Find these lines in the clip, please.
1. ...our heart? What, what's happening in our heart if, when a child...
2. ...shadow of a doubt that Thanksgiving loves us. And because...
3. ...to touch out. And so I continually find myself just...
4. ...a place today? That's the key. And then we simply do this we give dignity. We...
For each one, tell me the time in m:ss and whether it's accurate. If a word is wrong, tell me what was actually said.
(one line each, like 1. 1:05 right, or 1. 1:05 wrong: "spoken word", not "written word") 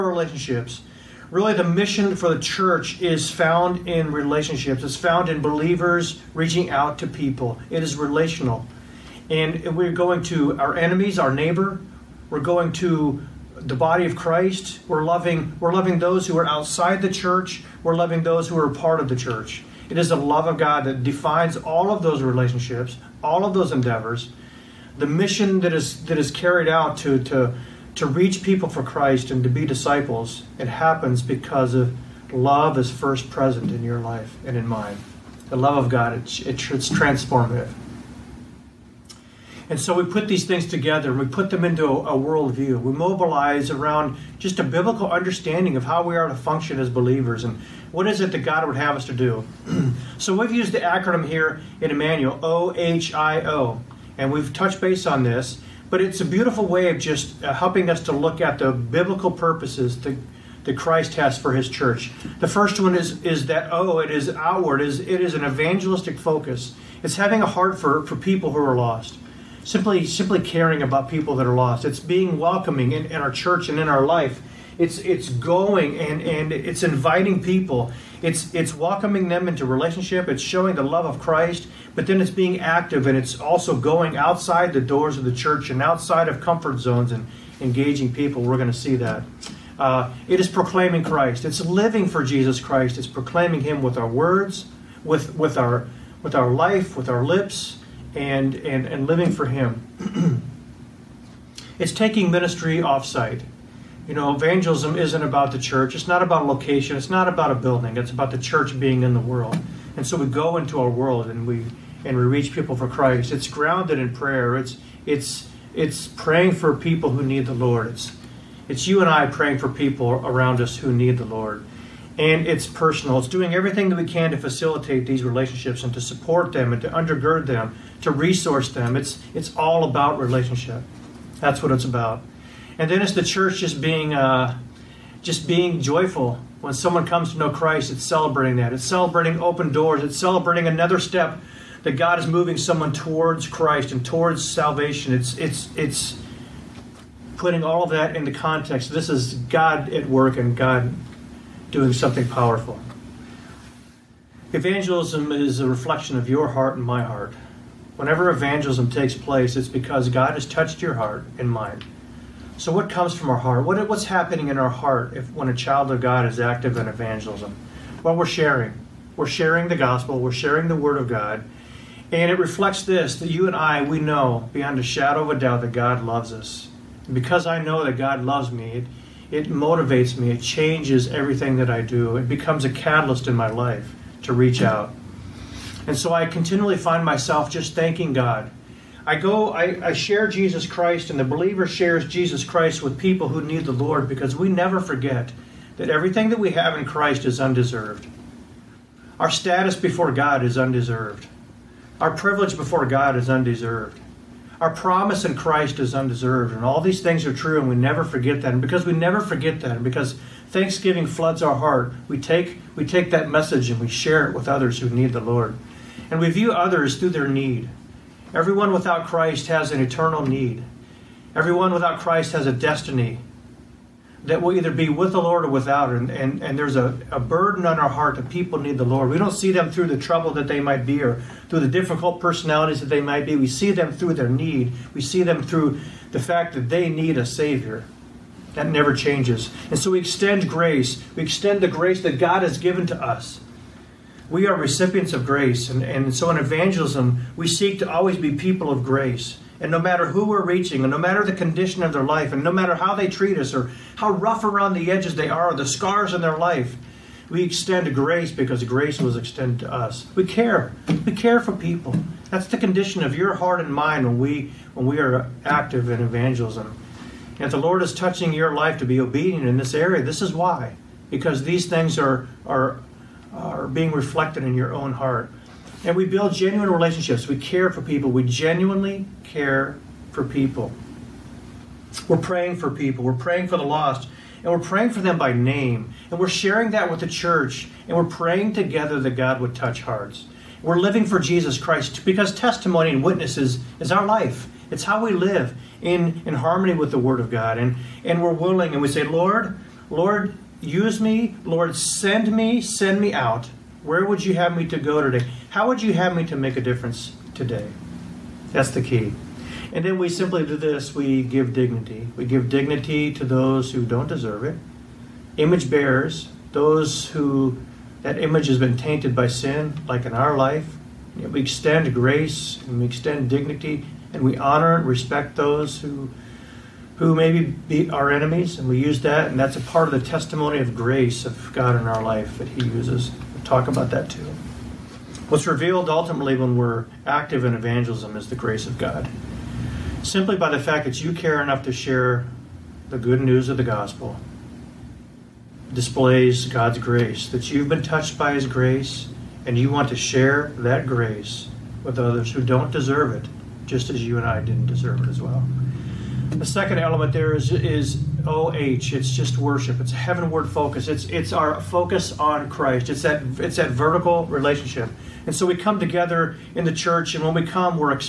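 1. 2:43 right
2. 2:54 wrong: "God", not "Thanksgiving"
3. 3:04 wrong: "reach", not "touch"
4. 5:06 wrong: "difference", not "place".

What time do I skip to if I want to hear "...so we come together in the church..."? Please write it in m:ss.
6:05.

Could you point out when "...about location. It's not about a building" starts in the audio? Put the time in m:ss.
1:46.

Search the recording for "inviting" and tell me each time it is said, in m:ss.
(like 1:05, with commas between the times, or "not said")
1:16.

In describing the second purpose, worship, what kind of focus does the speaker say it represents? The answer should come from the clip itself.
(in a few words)
heavenward focus.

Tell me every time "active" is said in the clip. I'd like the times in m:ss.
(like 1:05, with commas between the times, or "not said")
1:22, 2:46, 4:25, 5:37.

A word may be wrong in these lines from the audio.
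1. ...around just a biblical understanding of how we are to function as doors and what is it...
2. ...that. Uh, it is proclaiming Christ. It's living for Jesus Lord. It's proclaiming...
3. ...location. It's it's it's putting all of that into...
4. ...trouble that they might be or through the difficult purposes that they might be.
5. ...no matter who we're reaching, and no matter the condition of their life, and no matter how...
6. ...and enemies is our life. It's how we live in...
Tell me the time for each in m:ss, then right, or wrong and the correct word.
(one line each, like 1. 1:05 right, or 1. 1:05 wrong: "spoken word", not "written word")
1. 0:43 wrong: "believers", not "doors"
2. 1:28 wrong: "Christ", not "Lord"
3. 2:24 wrong: "salvation", not "location"
4. 3:49 wrong: "personalities", not "purposes"
5. 4:09 right
6. 4:52 wrong: "witnesses", not "enemies".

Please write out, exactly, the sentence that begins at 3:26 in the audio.
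And all these things are true, and we never forget that.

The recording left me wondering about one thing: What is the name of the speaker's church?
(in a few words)
Emmanuel.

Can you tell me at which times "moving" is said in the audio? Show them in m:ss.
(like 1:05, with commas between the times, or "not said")
2:22.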